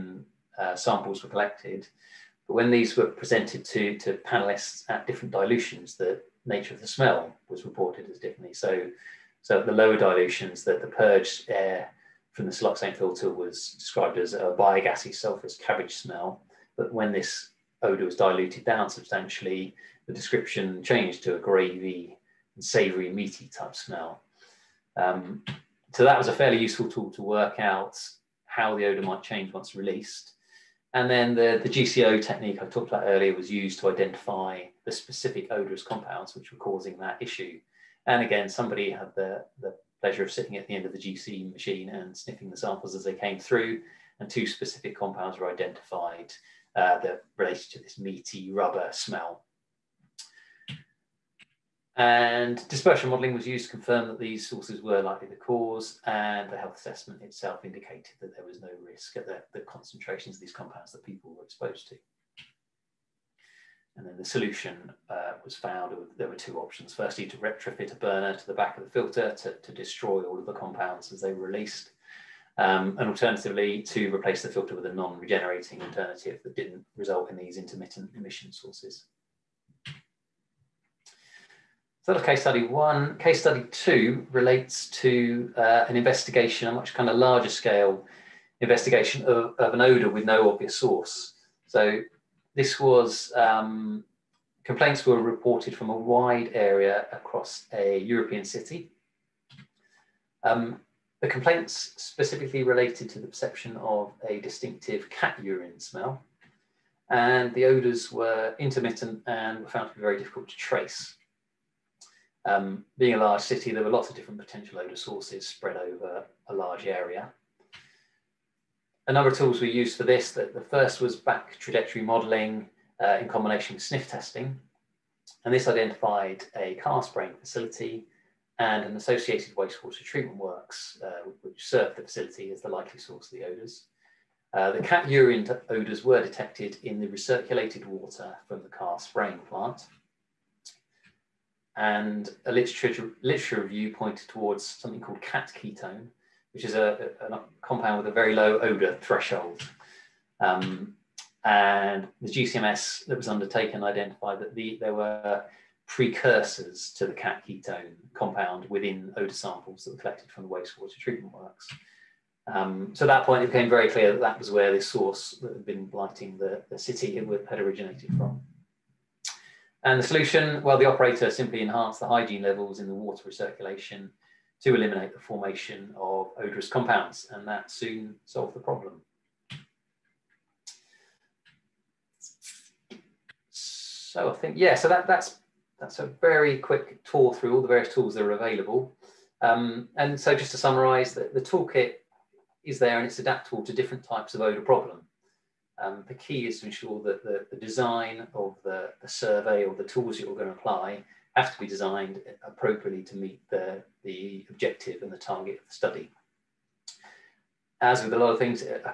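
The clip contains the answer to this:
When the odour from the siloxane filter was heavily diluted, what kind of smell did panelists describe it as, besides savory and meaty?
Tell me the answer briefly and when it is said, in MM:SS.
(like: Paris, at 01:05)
gravy, at 00:21.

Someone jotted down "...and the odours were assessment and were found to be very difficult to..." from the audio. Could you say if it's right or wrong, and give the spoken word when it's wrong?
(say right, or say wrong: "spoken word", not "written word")
wrong: "intermittent", not "assessment".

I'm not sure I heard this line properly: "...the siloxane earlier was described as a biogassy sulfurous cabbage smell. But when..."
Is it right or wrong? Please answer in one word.
wrong.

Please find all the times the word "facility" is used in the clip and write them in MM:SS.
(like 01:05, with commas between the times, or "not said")
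02:07, 02:12.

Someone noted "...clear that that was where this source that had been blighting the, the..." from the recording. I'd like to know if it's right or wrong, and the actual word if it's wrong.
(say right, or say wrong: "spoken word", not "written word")
right.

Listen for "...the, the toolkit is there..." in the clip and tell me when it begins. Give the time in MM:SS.
03:11.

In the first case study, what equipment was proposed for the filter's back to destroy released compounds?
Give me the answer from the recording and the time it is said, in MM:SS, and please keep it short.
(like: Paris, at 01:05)
a burner, at 01:07.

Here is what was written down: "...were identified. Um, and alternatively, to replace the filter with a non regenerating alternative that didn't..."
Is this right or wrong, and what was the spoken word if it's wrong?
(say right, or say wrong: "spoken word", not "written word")
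wrong: "released", not "identified".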